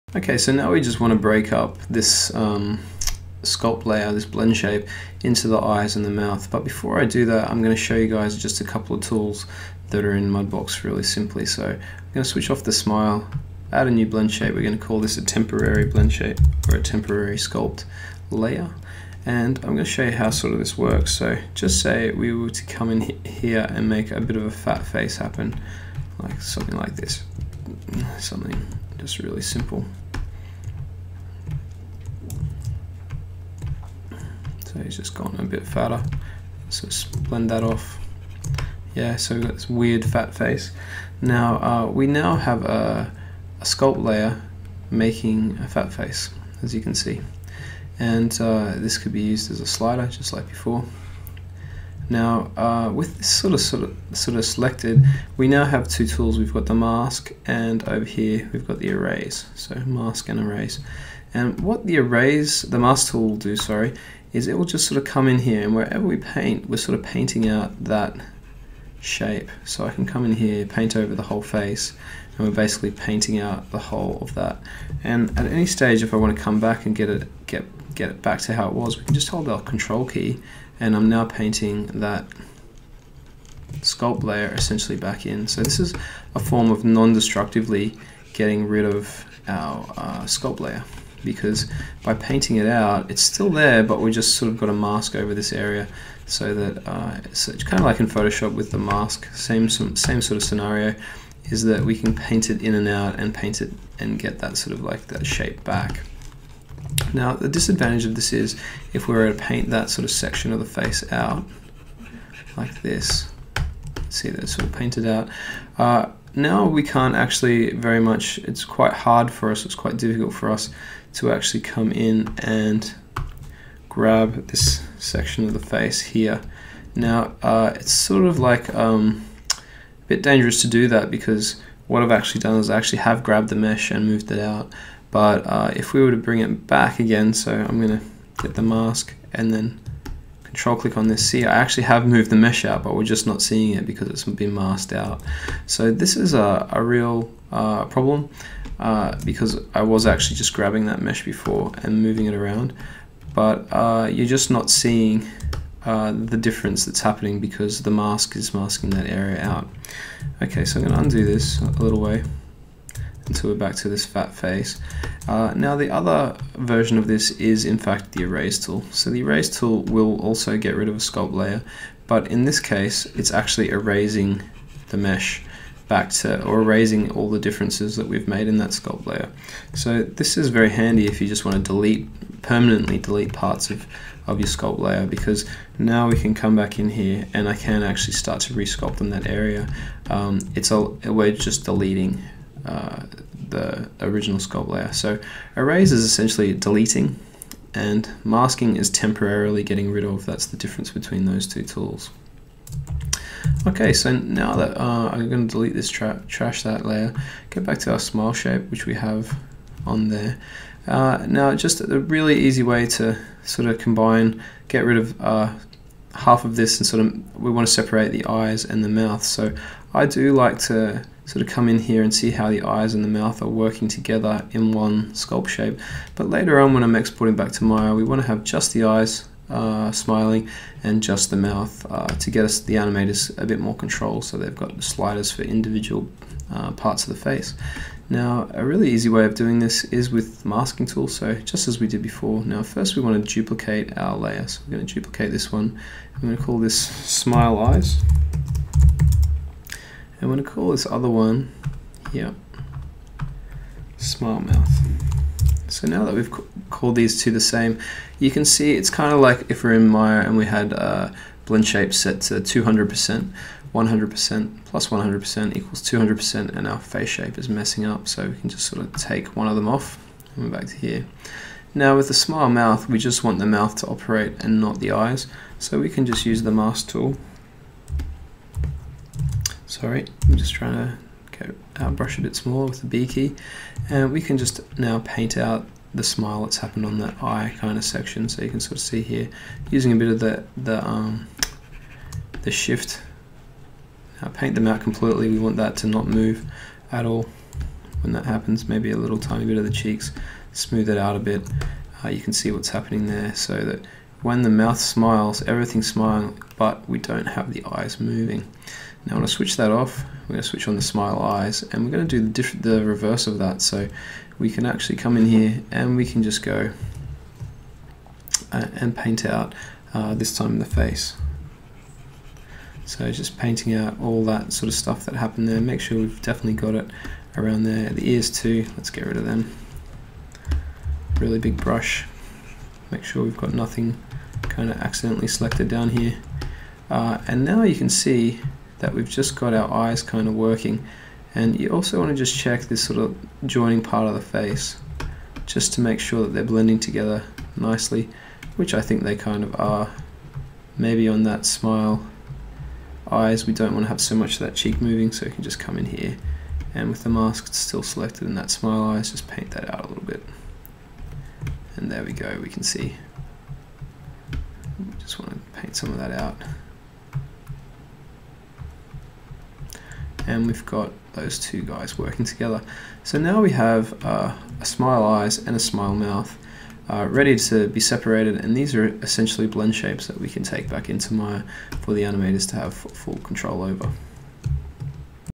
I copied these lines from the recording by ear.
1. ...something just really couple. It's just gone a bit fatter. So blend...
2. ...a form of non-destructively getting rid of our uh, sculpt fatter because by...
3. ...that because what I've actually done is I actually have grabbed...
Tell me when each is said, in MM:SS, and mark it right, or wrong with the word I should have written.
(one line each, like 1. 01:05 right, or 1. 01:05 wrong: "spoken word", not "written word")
1. 00:28 wrong: "simple", not "couple"
2. 01:26 wrong: "layer", not "fatter"
3. 02:10 right.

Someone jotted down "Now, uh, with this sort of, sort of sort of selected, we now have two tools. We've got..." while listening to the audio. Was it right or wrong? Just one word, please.
right.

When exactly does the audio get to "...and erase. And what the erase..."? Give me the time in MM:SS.
01:00.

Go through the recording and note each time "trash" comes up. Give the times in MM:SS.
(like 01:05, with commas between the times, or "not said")
03:26.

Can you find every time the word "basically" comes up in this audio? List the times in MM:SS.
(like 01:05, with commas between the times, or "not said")
01:12.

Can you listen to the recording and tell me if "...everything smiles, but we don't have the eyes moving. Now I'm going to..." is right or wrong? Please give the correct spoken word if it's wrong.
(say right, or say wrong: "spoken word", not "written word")
right.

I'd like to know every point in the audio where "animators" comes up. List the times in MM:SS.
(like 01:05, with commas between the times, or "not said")
03:52, 06:22.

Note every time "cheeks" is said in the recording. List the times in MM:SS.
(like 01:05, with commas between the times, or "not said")
04:59, 05:54.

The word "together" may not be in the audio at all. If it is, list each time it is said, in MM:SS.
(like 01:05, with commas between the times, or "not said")
03:43, 05:46, 06:12.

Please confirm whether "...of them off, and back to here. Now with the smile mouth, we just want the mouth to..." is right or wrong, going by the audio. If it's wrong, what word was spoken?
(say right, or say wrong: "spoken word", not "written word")
right.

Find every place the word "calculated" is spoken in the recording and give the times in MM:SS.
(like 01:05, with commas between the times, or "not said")
not said.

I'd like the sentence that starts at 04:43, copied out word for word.
And uh, we can just now paint out the smile that's happened on that eye kind of section.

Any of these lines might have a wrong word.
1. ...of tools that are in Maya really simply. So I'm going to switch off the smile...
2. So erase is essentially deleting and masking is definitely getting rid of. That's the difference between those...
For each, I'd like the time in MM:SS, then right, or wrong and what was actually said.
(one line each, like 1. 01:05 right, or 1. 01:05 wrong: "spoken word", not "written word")
1. 00:08 wrong: "Mudbox", not "Maya"
2. 03:14 wrong: "temporarily", not "definitely".